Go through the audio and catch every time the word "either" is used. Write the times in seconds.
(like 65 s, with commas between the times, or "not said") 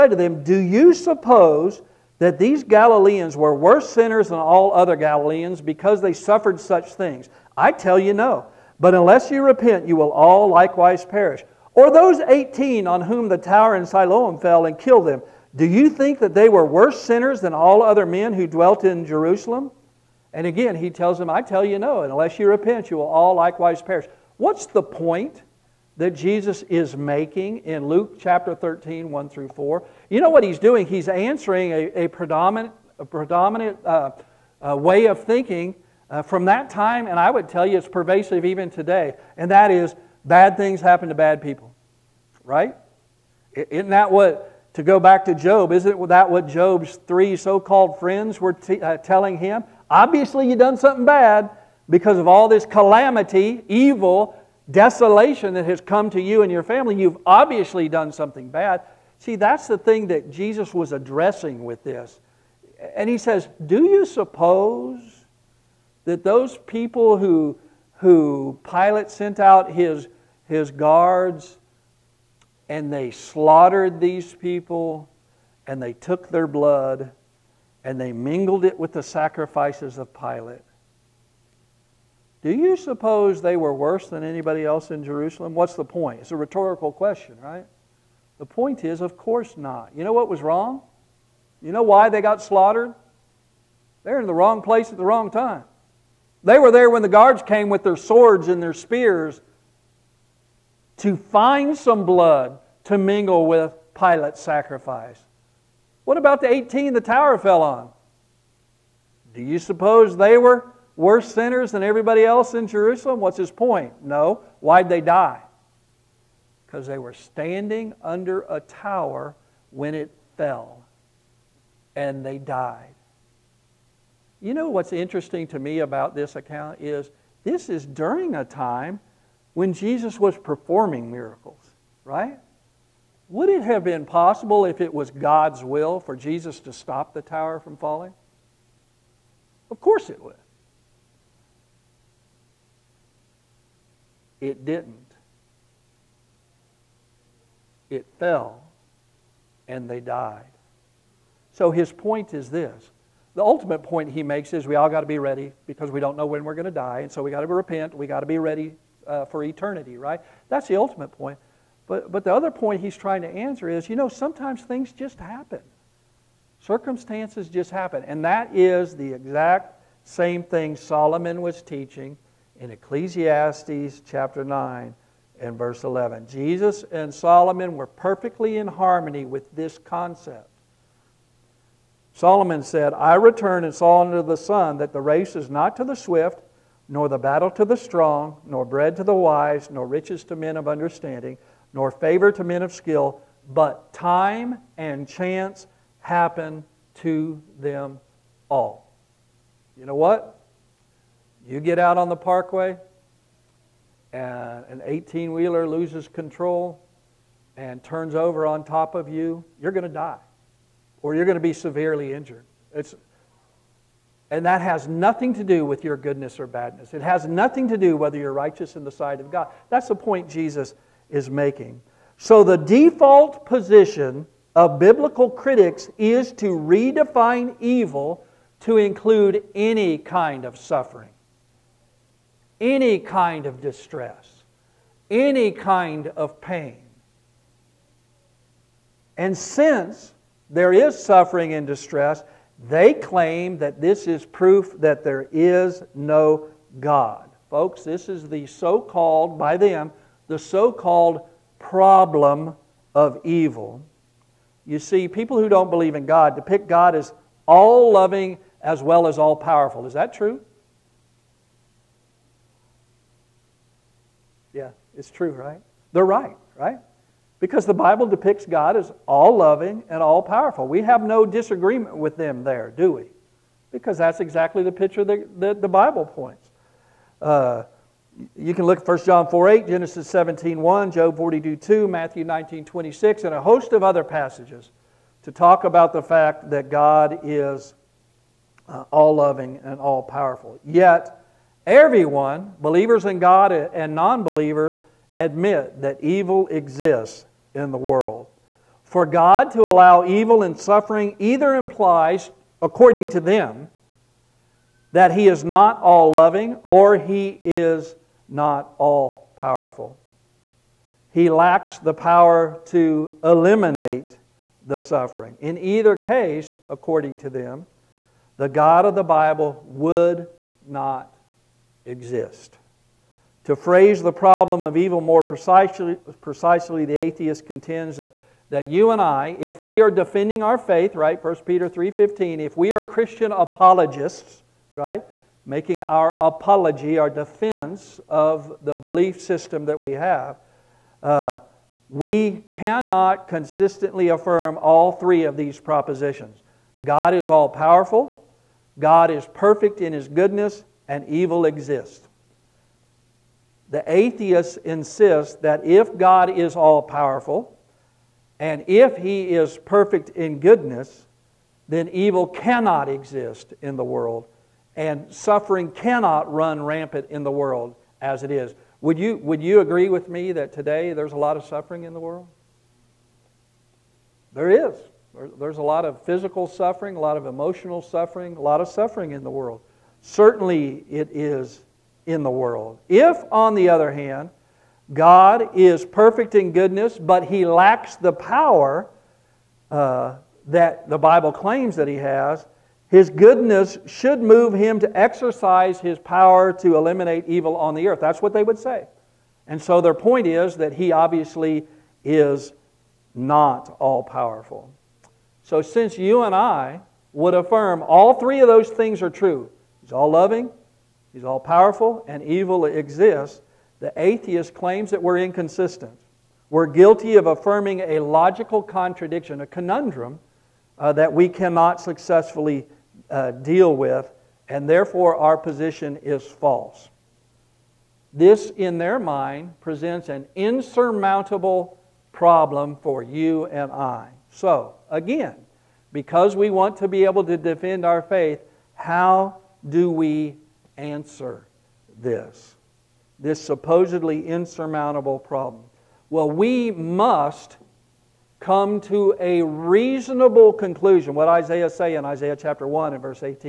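301 s, 315 s.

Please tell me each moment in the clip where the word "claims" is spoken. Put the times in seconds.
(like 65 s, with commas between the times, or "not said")
242 s, 391 s, 414 s.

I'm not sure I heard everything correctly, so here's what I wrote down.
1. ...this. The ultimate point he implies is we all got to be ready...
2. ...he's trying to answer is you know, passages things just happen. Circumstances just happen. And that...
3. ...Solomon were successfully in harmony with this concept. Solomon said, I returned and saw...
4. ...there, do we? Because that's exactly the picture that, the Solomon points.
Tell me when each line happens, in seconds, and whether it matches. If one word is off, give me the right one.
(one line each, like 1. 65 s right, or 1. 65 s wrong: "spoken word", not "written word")
1. 152 s wrong: "makes", not "implies"
2. 162 s wrong: "sometimes", not "passages"
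3. 177 s wrong: "perfectly", not "successfully"
4. 272 s wrong: "Bible", not "Solomon".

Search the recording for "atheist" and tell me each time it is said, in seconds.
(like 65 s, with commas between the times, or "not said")
326 s, 353 s, 413 s.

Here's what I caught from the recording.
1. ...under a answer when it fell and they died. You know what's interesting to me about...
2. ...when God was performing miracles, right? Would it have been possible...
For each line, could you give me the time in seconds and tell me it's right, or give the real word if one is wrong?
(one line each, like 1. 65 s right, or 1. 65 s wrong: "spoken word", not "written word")
1. 118 s wrong: "tower", not "answer"
2. 129 s wrong: "Jesus", not "God".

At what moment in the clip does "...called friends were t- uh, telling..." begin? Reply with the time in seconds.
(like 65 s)
47 s.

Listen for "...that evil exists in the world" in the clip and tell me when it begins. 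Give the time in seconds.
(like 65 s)
295 s.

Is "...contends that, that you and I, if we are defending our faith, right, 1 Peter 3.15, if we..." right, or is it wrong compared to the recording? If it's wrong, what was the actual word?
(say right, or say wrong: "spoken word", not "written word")
right.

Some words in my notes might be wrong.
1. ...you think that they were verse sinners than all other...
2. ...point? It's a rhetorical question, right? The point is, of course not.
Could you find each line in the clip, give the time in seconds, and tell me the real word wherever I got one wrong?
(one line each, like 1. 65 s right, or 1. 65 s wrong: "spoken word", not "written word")
1. 15 s wrong: "worse", not "verse"
2. 85 s right.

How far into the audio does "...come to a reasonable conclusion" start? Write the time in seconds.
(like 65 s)
448 s.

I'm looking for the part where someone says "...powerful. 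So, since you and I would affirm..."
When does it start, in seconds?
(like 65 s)
404 s.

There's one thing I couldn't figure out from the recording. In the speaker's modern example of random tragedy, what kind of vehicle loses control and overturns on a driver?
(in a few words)
18 wheeler.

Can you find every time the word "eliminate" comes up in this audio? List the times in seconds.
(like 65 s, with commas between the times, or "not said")
313 s, 396 s.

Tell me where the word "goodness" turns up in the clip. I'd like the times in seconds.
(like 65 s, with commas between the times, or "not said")
215 s, 350 s, 360 s, 386 s, 393 s.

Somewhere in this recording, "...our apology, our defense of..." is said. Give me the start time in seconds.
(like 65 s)
335 s.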